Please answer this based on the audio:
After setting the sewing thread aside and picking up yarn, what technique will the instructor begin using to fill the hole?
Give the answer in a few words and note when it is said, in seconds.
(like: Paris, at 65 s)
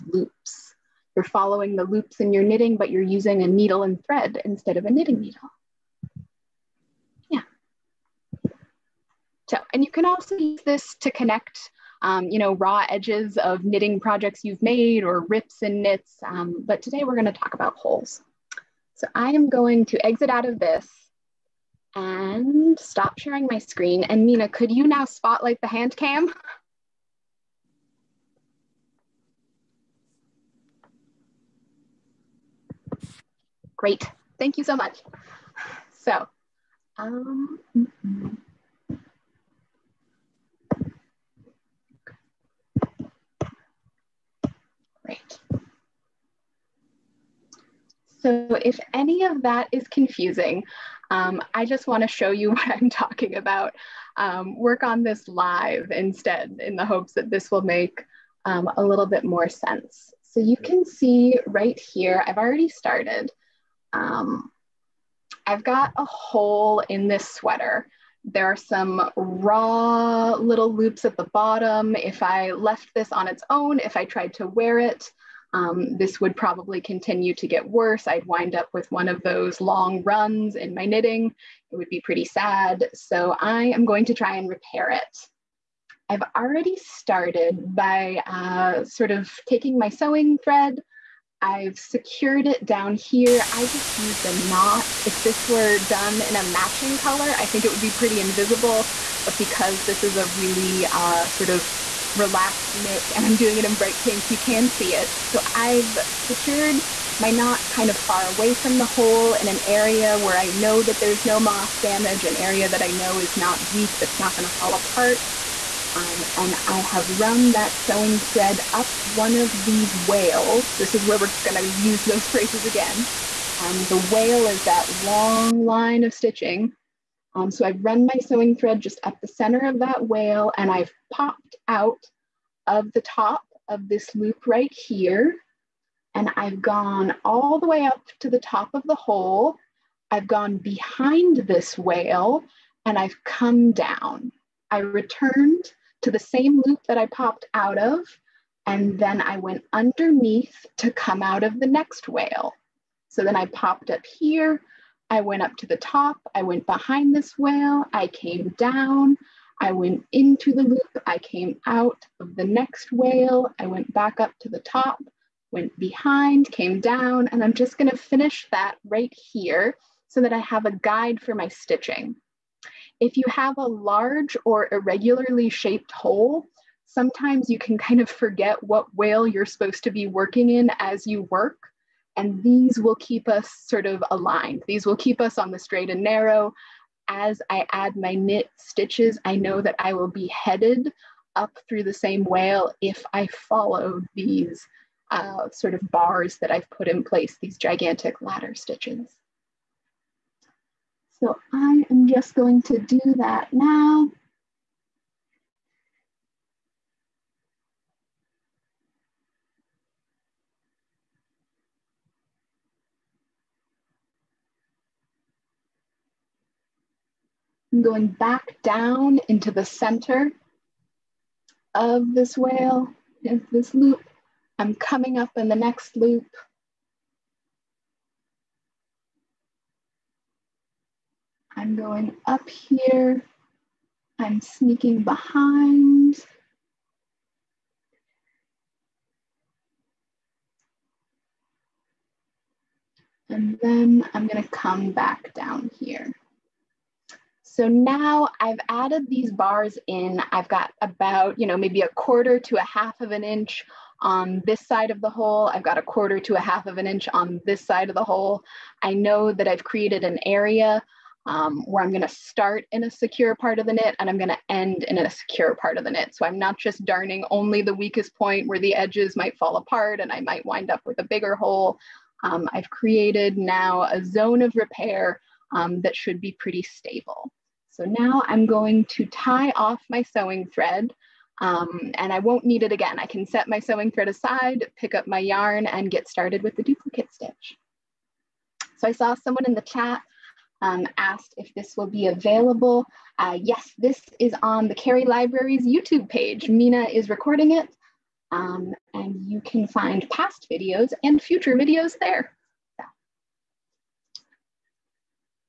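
duplicate stitch, at 286 s.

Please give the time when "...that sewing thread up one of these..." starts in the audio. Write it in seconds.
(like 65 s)
117 s.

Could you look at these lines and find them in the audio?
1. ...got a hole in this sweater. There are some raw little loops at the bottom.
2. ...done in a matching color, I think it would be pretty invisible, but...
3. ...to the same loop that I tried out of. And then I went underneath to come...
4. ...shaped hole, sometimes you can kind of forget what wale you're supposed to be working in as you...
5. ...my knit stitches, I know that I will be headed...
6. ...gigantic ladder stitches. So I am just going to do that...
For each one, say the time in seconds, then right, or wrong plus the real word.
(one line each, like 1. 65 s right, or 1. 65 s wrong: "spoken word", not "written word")
1. 65 s right
2. 95 s right
3. 146 s wrong: "popped", not "tried"
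4. 175 s right
5. 187 s right
6. 197 s right.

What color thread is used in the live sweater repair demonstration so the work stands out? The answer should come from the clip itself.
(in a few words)
bright pink.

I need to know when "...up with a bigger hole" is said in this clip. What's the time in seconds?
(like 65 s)
270 s.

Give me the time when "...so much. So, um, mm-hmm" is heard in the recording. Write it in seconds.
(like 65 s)
34 s.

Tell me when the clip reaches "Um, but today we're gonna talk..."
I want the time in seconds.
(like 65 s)
16 s.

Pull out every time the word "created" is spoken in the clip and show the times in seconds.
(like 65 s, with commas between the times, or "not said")
259 s, 272 s.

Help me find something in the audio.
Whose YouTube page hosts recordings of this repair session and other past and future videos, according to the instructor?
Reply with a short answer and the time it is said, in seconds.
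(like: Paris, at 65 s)
Cary Library, at 294 s.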